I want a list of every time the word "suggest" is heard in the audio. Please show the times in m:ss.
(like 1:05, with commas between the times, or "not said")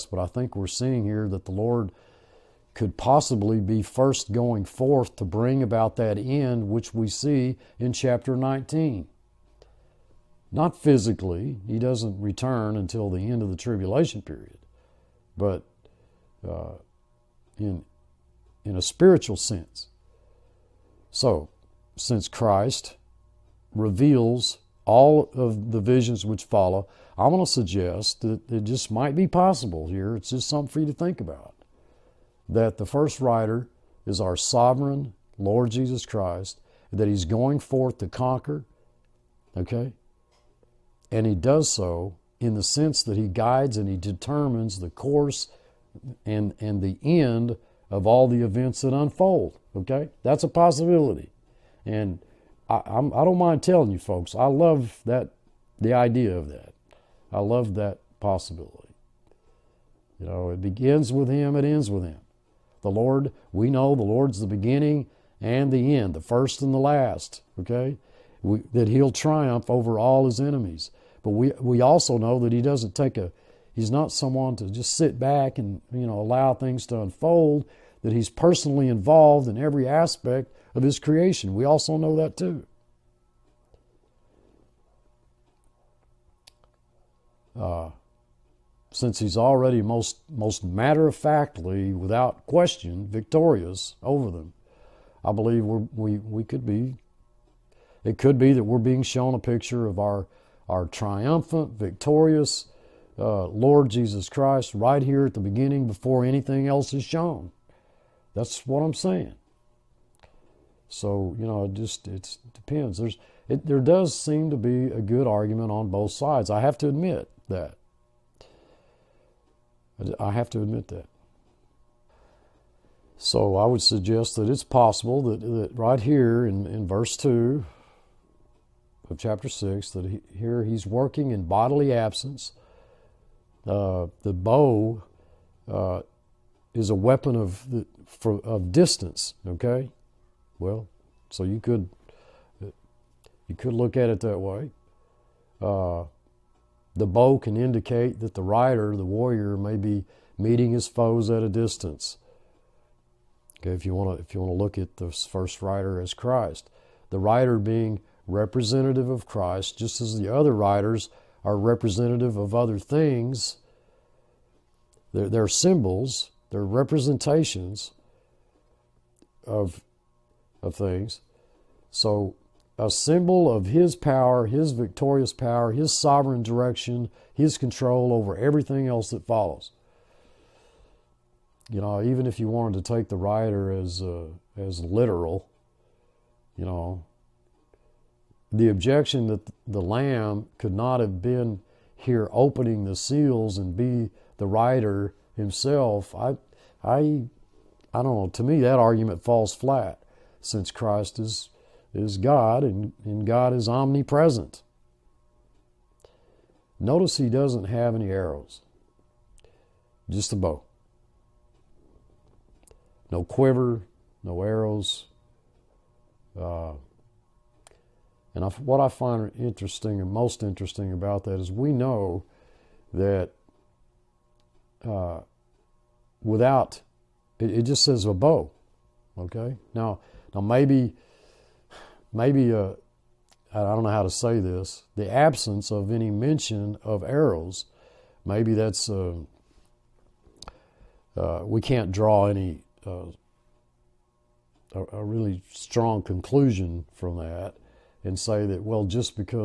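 0:27, 2:03.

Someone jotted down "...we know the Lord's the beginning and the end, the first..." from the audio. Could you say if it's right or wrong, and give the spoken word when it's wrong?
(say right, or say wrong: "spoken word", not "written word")
right.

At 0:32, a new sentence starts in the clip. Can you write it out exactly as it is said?
That the first rider is our sovereign Lord Jesus Christ, that he's going forth to conquer, okay?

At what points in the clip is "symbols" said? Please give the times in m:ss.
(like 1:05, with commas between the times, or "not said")
2:45, 2:52.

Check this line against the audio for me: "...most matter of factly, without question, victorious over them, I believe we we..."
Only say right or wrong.
right.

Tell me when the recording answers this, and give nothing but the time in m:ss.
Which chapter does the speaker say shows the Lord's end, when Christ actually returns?
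0:07.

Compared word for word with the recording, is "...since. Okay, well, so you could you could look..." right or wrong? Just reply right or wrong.
wrong.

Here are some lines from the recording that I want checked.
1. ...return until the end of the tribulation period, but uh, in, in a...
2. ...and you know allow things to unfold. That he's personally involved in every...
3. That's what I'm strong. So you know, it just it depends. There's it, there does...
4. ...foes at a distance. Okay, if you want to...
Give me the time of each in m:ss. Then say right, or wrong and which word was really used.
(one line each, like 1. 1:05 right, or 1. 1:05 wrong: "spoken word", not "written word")
1. 0:12 right
2. 1:15 right
3. 1:48 wrong: "saying", not "strong"
4. 2:30 right.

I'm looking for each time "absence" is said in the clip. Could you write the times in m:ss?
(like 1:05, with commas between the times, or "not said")
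2:11, 3:55.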